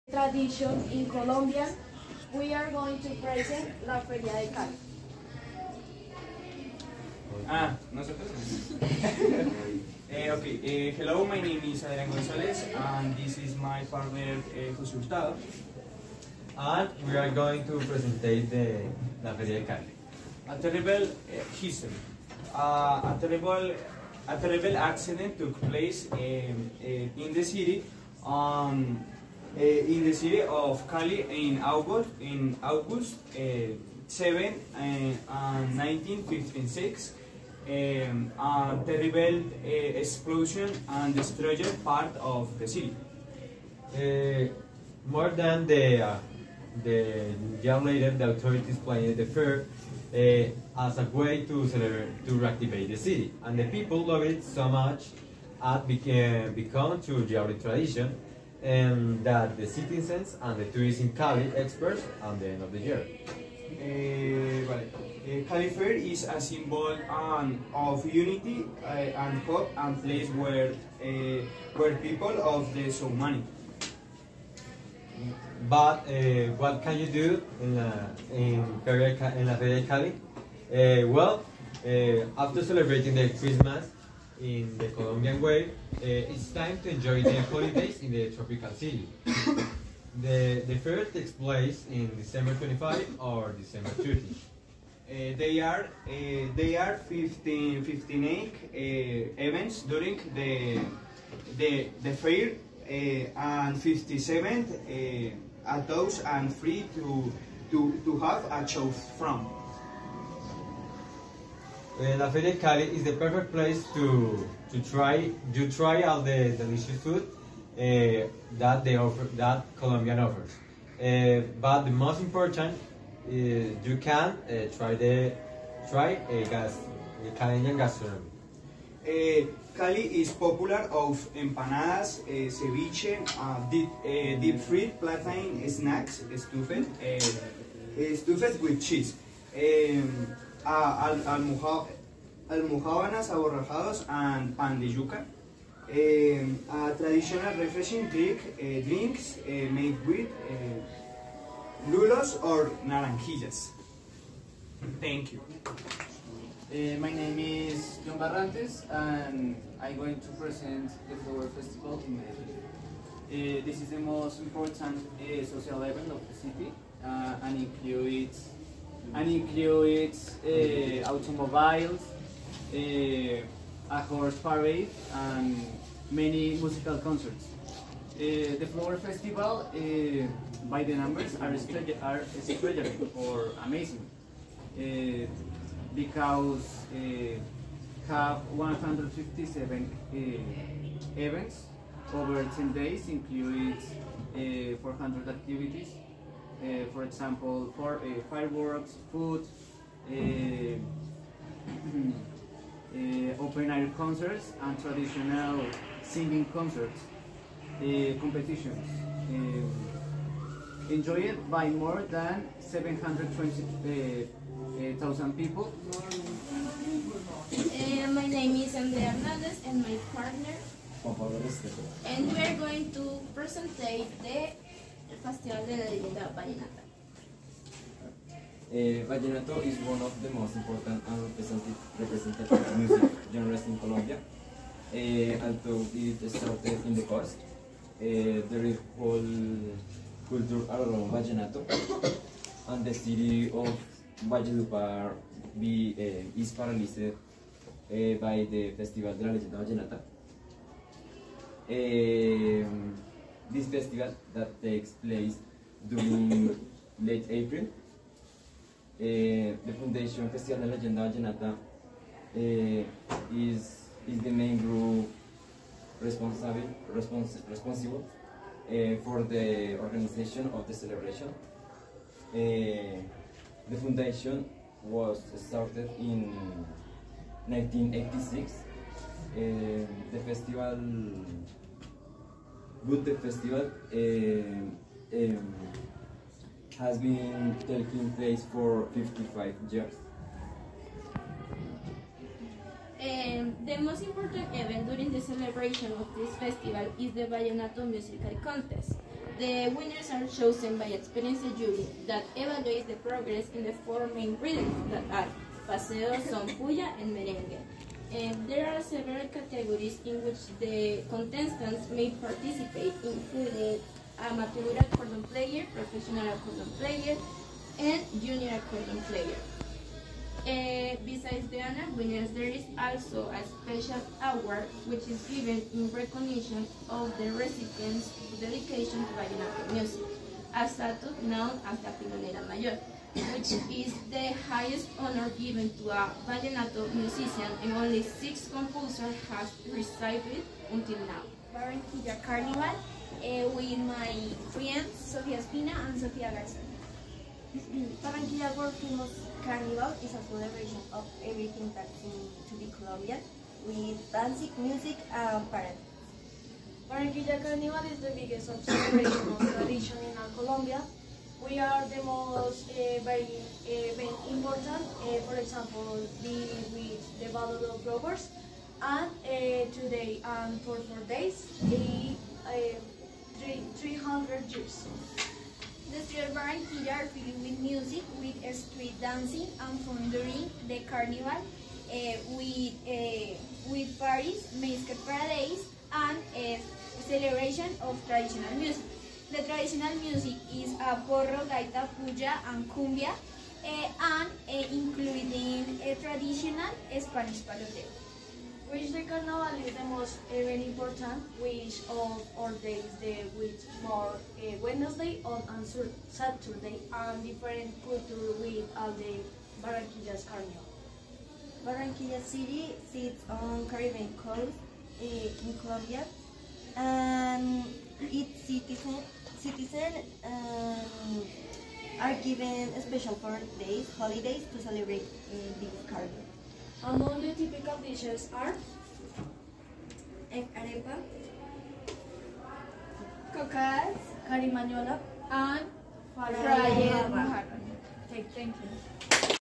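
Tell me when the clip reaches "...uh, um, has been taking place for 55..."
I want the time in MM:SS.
04:43.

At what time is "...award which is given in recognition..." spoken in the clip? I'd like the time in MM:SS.
05:24.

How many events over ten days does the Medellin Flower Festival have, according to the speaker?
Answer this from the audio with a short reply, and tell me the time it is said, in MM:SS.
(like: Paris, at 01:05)
157, at 03:08.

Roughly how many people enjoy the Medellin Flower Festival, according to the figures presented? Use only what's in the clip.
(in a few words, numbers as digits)
720,000.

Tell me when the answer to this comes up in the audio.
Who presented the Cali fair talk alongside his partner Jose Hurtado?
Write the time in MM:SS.
00:11.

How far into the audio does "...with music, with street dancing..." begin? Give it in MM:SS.
06:17.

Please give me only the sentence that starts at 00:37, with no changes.
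Um, uh, eh, the rebel uh, explosion and destroyed part of the city.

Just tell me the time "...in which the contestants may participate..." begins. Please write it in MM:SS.
05:10.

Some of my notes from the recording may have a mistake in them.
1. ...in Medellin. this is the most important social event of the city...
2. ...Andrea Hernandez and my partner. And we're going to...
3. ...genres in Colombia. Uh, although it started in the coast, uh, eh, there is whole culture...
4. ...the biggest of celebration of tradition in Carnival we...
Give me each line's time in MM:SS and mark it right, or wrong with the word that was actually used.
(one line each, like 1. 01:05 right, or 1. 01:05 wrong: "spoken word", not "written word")
1. 02:42 right
2. 03:38 right
3. 03:53 right
4. 05:57 wrong: "Colombia", not "Carnival".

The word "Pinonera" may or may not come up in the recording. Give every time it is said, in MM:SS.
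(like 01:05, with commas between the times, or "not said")
05:31.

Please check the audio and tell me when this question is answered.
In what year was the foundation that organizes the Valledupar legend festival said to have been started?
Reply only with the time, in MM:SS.
04:37.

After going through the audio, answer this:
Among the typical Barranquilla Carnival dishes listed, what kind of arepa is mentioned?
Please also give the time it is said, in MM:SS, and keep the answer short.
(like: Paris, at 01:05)
egg arepa, at 07:10.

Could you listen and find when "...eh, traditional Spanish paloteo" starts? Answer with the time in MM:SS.
06:35.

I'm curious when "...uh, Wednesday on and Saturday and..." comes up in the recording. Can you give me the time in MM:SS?
06:44.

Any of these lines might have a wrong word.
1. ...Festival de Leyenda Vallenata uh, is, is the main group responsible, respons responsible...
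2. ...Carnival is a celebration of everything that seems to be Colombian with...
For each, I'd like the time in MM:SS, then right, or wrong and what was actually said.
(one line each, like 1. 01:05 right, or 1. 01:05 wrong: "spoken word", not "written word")
1. 04:20 right
2. 05:49 right.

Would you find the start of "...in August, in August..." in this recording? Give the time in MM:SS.
00:31.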